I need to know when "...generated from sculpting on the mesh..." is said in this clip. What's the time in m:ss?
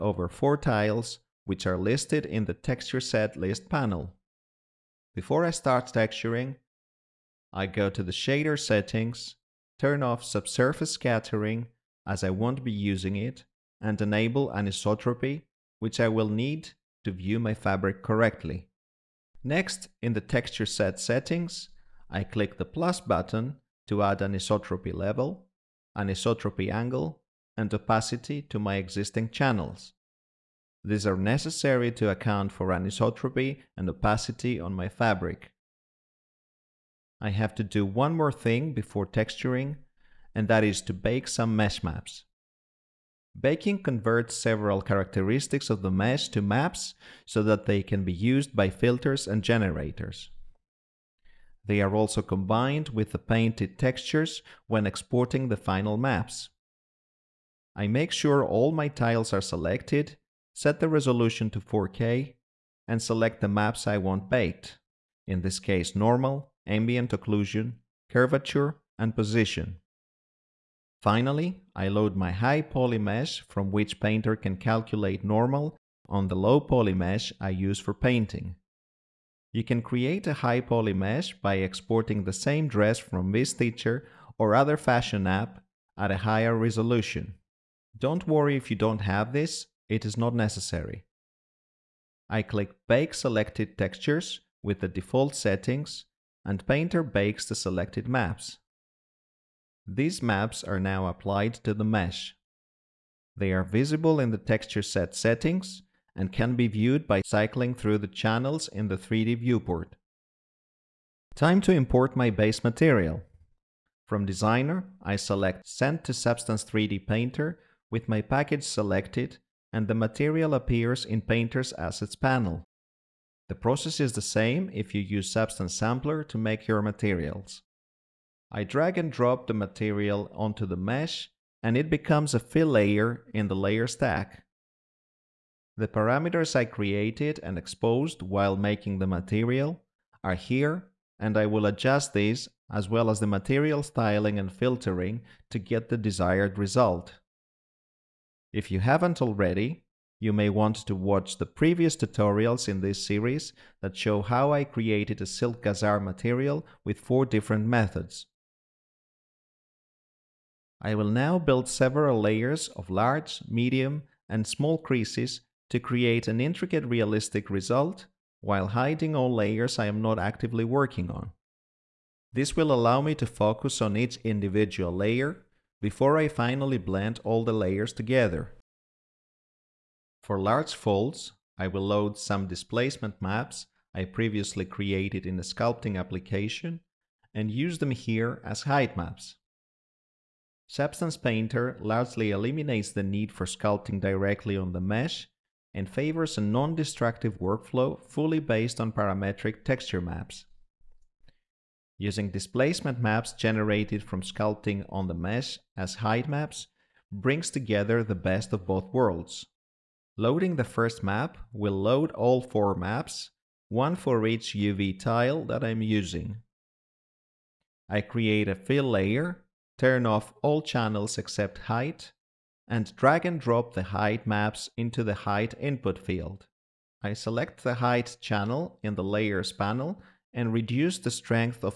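3:23.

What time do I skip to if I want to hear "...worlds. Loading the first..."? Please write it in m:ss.
3:28.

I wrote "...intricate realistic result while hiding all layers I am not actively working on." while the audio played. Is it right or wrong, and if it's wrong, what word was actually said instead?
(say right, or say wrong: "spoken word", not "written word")
right.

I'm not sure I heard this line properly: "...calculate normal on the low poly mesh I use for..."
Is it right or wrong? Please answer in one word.
right.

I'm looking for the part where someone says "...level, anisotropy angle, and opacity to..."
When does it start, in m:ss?
0:24.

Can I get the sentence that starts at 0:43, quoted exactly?
Baking converts several characteristics of the mesh to maps so that they can be used by filters and generators.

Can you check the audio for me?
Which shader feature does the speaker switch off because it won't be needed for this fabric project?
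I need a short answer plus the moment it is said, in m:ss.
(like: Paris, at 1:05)
subsurface scattering, at 0:10.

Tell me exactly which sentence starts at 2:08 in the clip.
I drag and drop the material onto the mesh and it becomes a fill layer in the layer stack.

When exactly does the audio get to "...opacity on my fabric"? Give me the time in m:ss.
0:33.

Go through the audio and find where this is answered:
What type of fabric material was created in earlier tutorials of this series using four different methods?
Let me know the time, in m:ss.
2:35.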